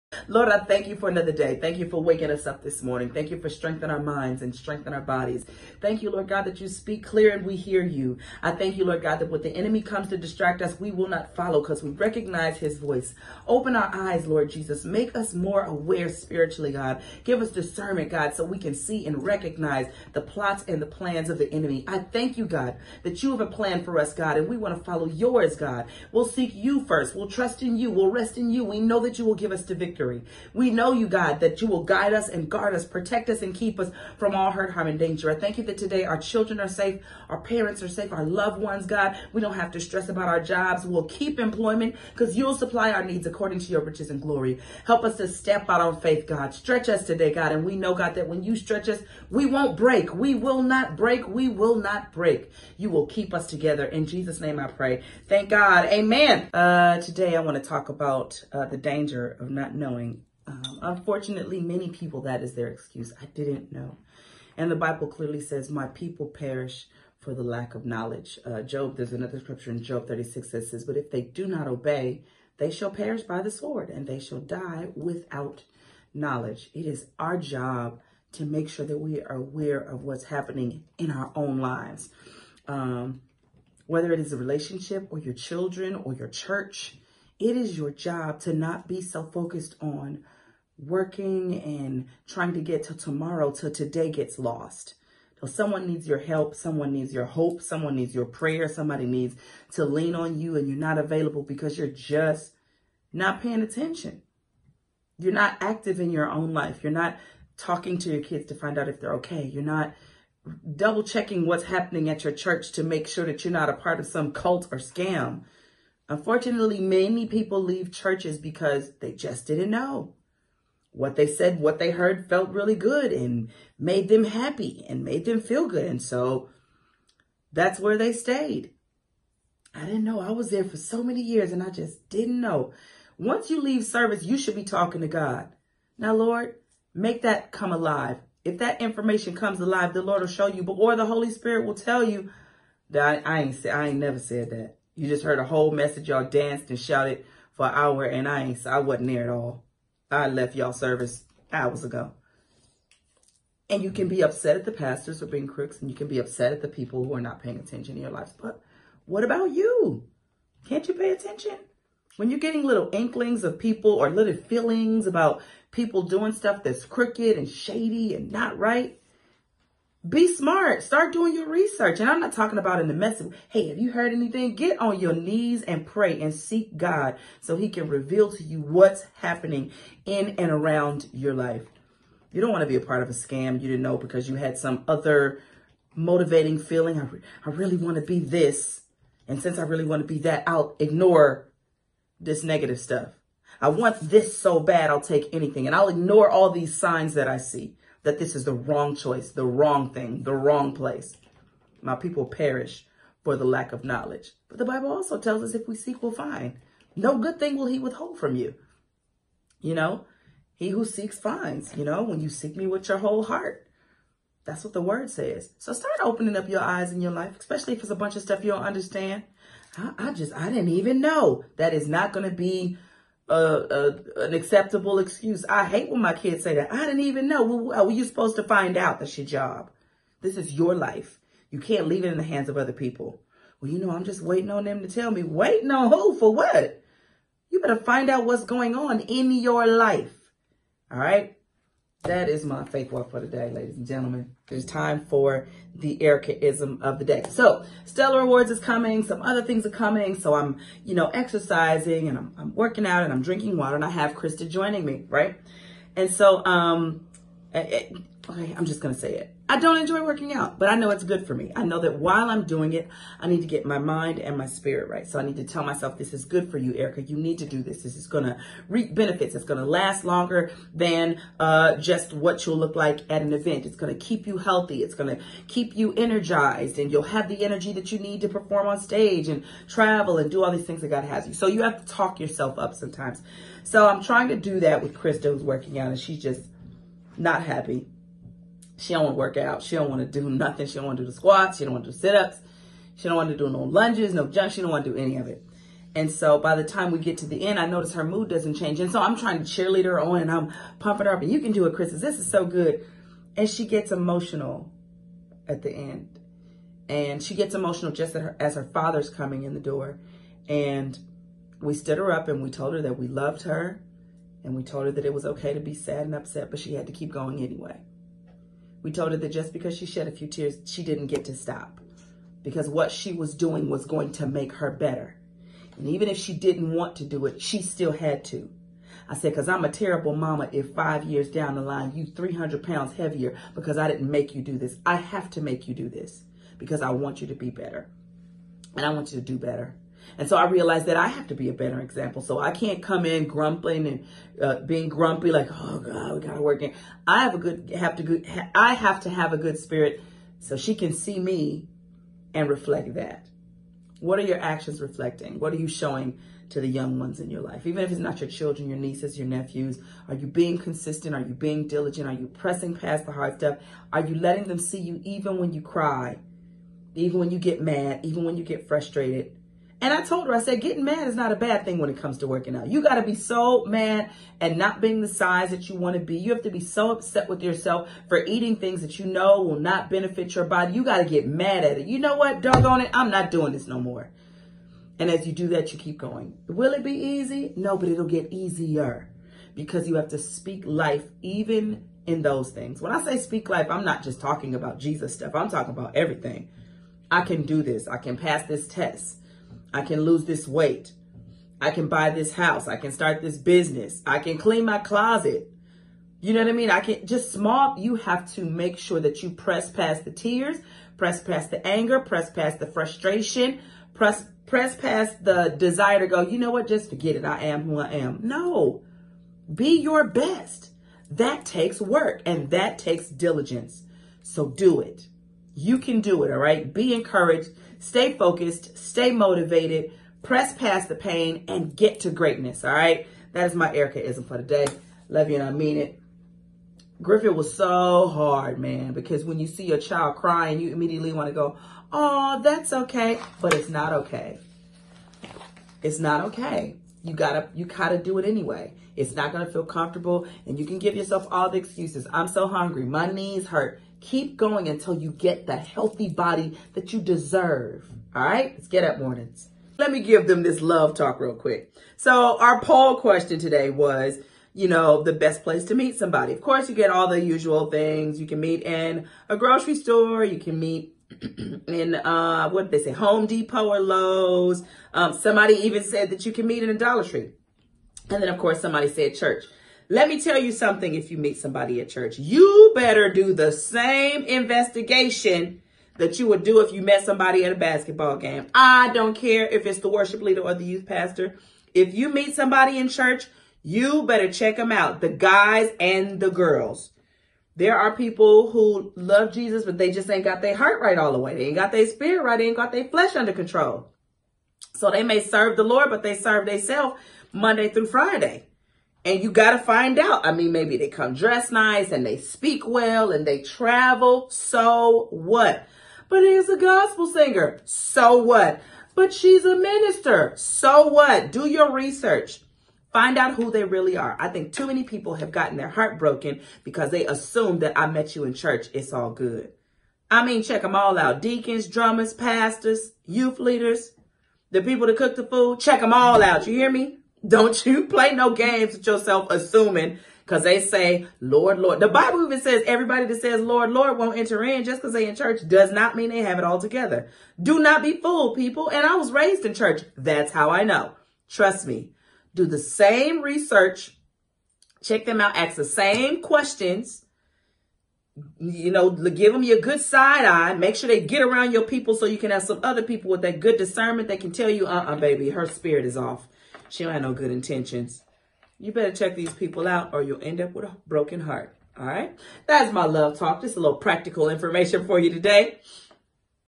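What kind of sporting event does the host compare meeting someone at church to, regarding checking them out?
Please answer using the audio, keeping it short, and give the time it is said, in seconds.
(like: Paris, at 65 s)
basketball game, at 487 s.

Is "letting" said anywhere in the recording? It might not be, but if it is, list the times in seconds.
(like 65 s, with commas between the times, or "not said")
364 s.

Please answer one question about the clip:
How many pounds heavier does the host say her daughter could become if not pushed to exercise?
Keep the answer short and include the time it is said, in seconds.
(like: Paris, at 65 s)
300, at 332 s.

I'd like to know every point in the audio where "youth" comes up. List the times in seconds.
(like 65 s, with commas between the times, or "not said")
490 s, 533 s.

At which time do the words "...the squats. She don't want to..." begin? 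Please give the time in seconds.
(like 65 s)
291 s.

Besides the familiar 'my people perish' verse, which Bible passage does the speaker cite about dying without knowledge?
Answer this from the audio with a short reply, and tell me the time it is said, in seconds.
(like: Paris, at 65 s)
Job 36, at 69 s.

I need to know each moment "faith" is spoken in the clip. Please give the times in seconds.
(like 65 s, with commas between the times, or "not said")
46 s, 242 s.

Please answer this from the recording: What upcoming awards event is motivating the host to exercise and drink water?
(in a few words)
Stellar Awards.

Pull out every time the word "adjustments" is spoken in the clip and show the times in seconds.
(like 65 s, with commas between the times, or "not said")
not said.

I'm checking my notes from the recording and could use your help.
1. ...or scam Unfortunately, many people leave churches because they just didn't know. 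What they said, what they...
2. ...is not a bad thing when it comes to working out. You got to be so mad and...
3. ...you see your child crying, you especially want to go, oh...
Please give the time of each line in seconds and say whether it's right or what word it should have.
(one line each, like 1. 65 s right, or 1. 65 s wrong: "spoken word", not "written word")
1. 114 s right
2. 371 s right
3. 439 s wrong: "immediately", not "especially".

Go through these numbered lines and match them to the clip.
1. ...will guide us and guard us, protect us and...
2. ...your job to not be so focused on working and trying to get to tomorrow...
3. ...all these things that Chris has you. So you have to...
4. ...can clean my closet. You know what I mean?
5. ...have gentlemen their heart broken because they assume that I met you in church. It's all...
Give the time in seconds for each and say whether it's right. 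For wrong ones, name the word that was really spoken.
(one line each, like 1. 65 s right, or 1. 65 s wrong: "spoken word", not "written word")
1. 31 s right
2. 87 s right
3. 280 s wrong: "God", not "Chris"
4. 404 s right
5. 525 s wrong: "gotten", not "gentlemen".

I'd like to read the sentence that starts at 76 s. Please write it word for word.
It is our job to make sure that we are aware of what's happening in our own lives.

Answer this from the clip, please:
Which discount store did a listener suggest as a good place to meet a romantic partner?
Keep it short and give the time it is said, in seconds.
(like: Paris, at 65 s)
Dollar Tree, at 476 s.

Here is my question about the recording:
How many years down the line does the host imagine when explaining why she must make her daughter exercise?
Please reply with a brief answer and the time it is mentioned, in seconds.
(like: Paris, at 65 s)
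5, at 330 s.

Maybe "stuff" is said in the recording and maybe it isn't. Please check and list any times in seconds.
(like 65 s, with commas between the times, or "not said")
166 s, 192 s, 218 s, 363 s, 395 s.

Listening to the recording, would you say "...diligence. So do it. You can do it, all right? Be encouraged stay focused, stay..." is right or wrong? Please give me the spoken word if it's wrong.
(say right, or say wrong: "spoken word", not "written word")
right.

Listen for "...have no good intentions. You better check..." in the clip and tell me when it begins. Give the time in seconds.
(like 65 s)
566 s.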